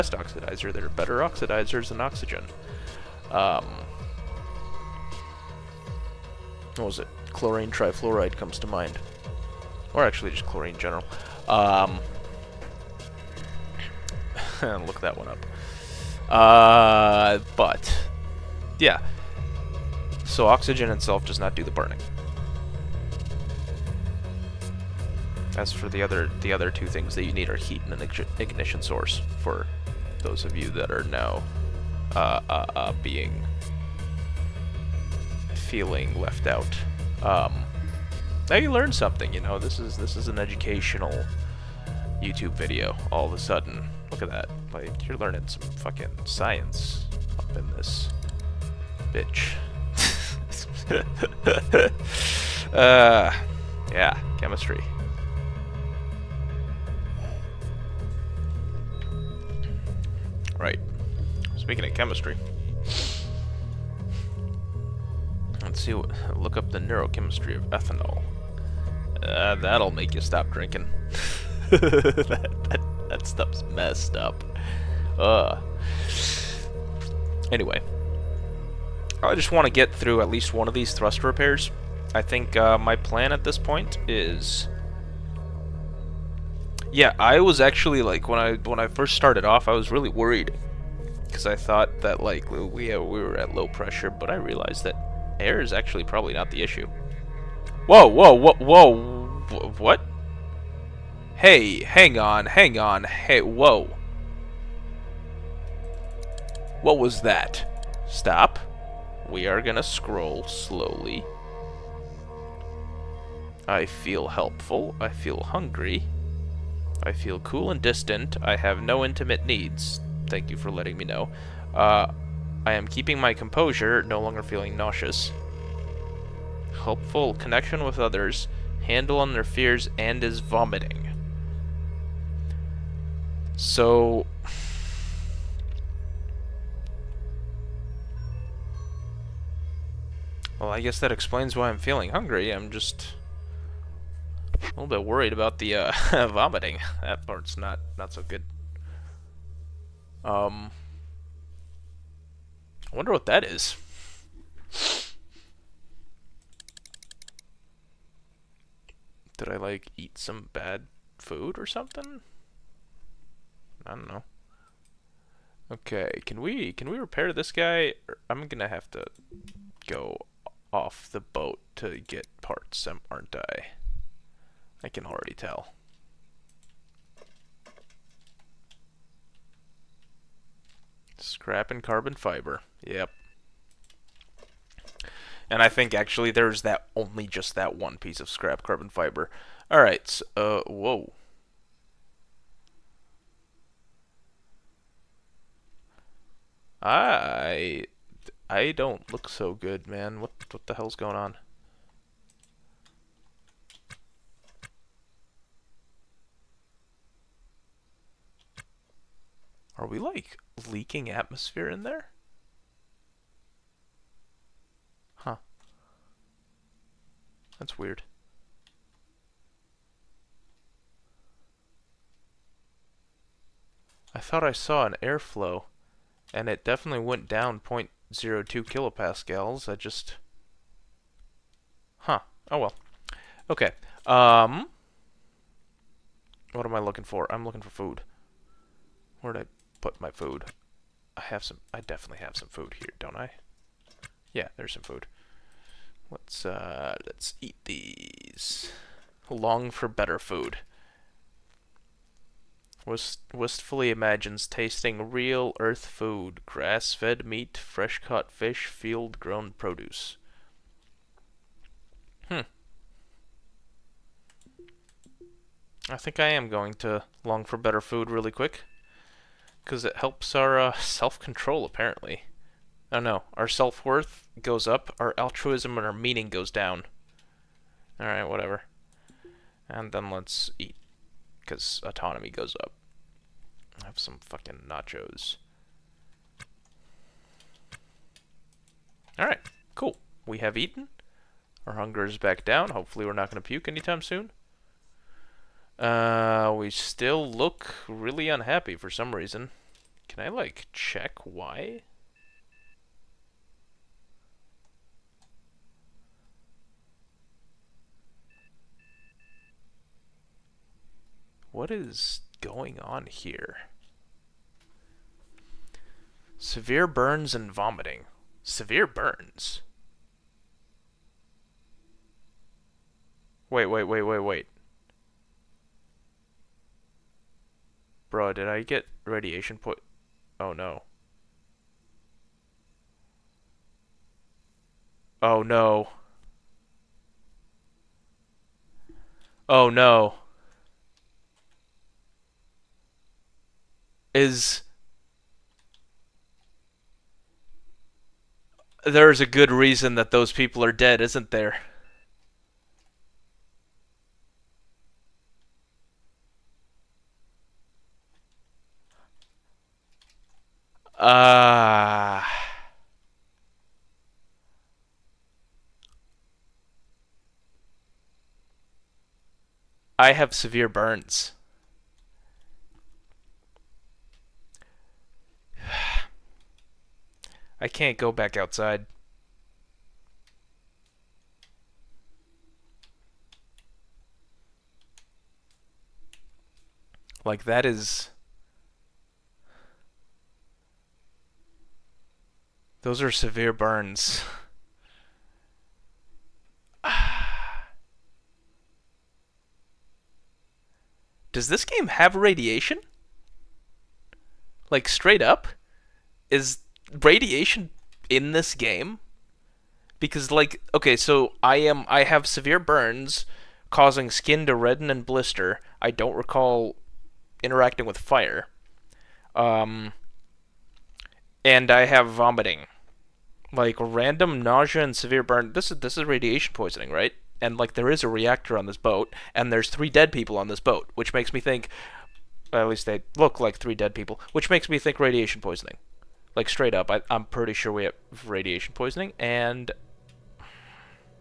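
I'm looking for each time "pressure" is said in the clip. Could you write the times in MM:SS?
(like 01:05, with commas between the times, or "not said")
01:33.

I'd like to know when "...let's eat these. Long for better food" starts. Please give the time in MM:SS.
04:07.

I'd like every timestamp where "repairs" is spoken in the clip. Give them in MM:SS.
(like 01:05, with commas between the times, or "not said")
01:21, 02:46.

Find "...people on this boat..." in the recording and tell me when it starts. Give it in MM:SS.
07:10.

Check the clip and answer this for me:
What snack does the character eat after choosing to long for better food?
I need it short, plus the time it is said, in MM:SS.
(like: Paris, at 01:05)
nachos, at 04:44.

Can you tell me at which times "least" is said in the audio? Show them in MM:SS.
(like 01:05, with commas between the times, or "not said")
01:20, 07:12.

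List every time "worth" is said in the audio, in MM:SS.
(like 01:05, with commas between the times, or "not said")
04:33.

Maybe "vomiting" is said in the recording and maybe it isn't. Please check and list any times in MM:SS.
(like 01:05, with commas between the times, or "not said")
02:10, 02:26, 05:17, 07:02.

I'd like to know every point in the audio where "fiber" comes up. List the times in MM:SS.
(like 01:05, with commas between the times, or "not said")
03:02, 03:08.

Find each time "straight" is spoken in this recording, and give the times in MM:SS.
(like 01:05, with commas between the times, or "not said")
06:44, 07:16.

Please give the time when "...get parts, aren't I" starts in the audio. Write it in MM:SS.
02:51.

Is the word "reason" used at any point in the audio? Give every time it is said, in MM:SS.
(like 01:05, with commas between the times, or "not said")
04:59, 05:49.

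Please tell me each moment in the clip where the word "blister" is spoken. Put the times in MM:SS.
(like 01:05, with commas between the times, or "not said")
06:55.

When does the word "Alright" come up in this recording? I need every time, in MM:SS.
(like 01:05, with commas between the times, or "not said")
04:38, 04:49.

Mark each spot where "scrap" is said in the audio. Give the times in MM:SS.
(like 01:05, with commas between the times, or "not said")
03:01, 03:08.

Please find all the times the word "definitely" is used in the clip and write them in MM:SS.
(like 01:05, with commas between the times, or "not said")
03:46, 04:01.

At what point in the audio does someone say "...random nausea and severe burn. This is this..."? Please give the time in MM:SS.
07:03.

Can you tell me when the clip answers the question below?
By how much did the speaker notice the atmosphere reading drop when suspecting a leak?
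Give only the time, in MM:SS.
03:47.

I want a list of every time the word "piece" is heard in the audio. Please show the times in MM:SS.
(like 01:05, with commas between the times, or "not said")
03:07.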